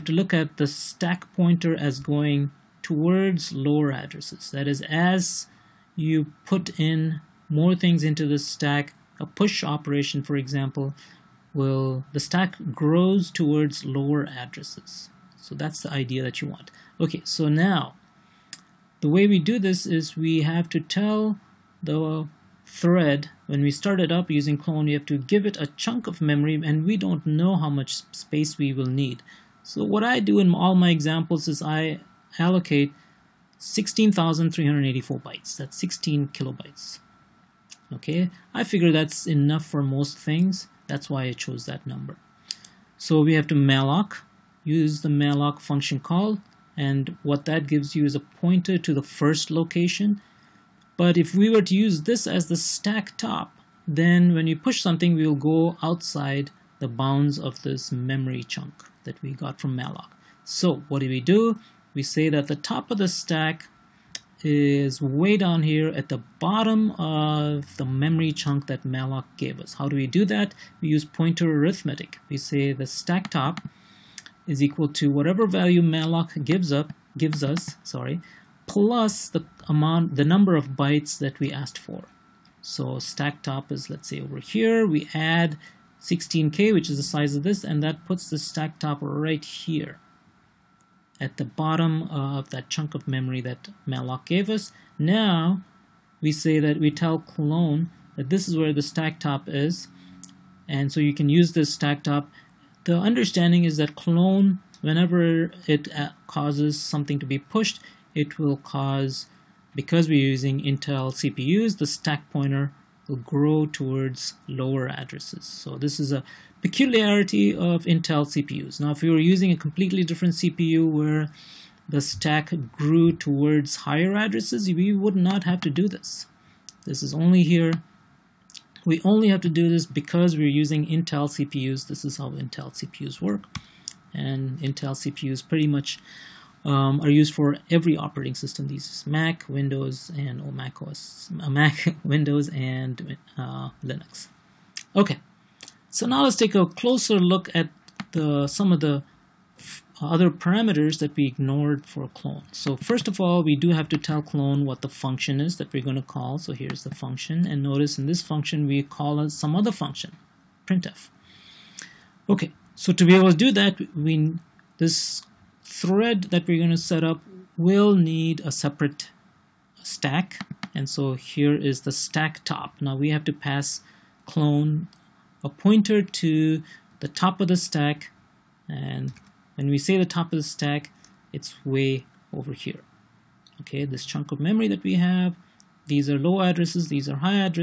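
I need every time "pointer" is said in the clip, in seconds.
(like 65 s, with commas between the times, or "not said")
1 s, 48 s, 71 s, 112 s, 175 s.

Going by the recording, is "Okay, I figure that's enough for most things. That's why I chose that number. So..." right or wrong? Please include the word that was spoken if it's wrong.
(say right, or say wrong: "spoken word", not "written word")
right.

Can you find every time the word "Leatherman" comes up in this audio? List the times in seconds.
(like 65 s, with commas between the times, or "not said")
not said.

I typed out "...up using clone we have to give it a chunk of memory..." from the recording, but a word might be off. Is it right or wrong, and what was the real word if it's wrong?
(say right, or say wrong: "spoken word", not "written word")
right.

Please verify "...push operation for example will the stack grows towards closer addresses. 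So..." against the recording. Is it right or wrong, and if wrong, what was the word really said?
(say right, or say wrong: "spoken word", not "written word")
wrong: "lower", not "closer".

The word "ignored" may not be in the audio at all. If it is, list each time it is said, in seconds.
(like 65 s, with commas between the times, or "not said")
151 s.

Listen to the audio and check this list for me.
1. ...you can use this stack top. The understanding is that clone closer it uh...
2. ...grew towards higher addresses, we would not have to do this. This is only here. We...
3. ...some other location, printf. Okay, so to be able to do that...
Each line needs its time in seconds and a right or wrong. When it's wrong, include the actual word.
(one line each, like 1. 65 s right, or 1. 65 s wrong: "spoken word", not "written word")
1. 100 s wrong: "whenever", not "closer"
2. 122 s right
3. 159 s wrong: "function", not "location".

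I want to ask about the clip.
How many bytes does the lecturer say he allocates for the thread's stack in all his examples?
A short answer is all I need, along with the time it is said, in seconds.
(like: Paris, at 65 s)
16,384, at 33 s.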